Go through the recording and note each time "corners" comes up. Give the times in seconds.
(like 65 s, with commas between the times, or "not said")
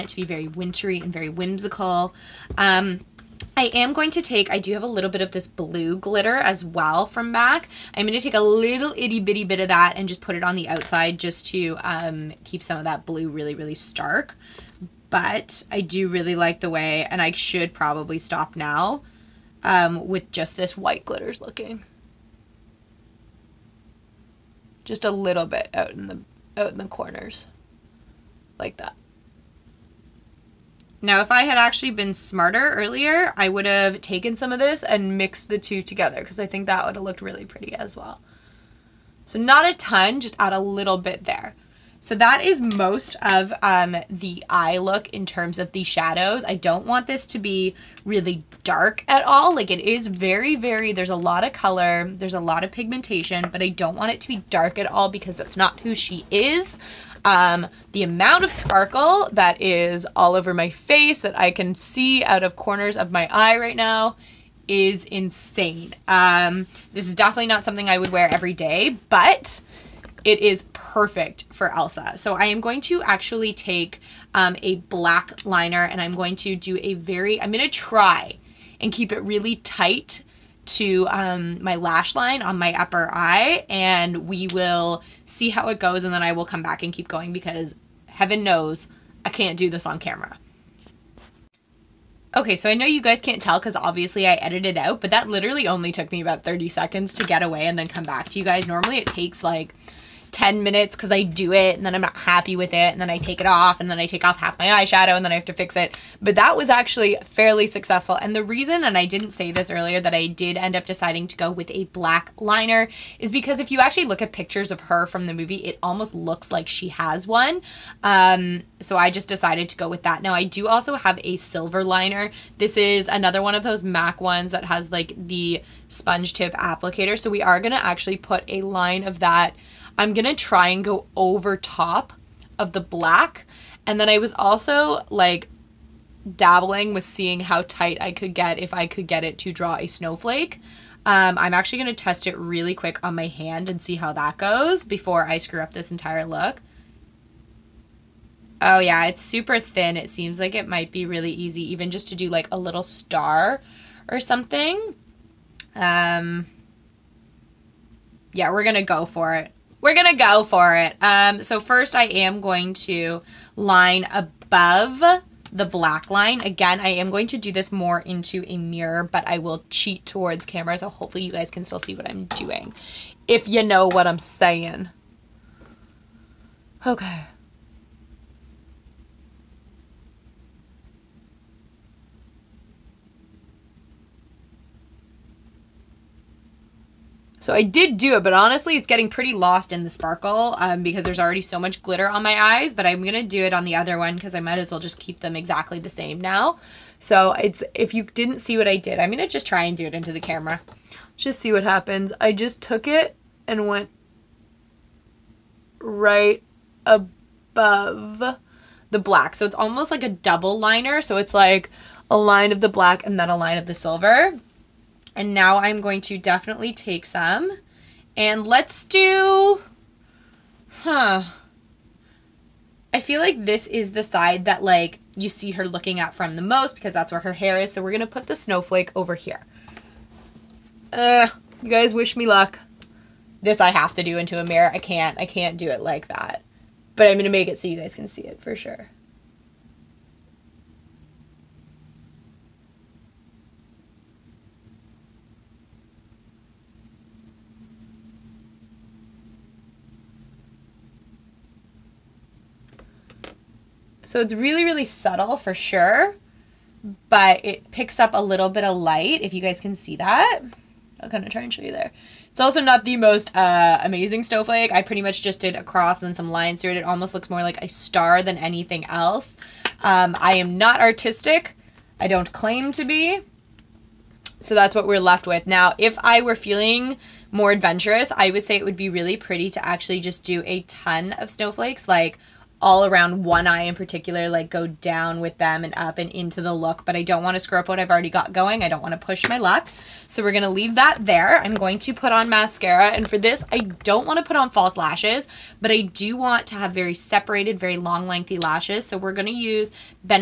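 26 s, 62 s.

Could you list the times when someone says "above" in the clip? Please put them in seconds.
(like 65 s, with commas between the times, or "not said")
164 s, 206 s.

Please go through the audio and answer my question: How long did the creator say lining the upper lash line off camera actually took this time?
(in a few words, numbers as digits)
30 seconds.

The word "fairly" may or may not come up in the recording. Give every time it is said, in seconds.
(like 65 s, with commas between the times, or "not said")
107 s.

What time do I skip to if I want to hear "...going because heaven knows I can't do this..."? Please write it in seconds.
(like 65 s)
87 s.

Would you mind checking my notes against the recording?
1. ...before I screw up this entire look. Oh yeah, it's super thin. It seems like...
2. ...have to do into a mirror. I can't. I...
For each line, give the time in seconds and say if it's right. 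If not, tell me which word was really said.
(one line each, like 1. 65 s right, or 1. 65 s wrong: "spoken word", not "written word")
1. 144 s right
2. 233 s right.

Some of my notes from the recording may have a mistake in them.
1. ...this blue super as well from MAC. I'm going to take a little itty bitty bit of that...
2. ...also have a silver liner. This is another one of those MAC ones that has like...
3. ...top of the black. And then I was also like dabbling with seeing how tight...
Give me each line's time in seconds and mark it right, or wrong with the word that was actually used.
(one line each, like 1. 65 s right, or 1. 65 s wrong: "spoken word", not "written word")
1. 5 s wrong: "glitter", not "super"
2. 120 s right
3. 131 s right.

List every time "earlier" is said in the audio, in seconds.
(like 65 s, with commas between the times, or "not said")
32 s, 109 s.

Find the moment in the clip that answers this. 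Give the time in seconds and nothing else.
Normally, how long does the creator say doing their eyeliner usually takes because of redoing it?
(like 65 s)
100 s.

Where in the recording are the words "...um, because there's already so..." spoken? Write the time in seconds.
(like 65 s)
190 s.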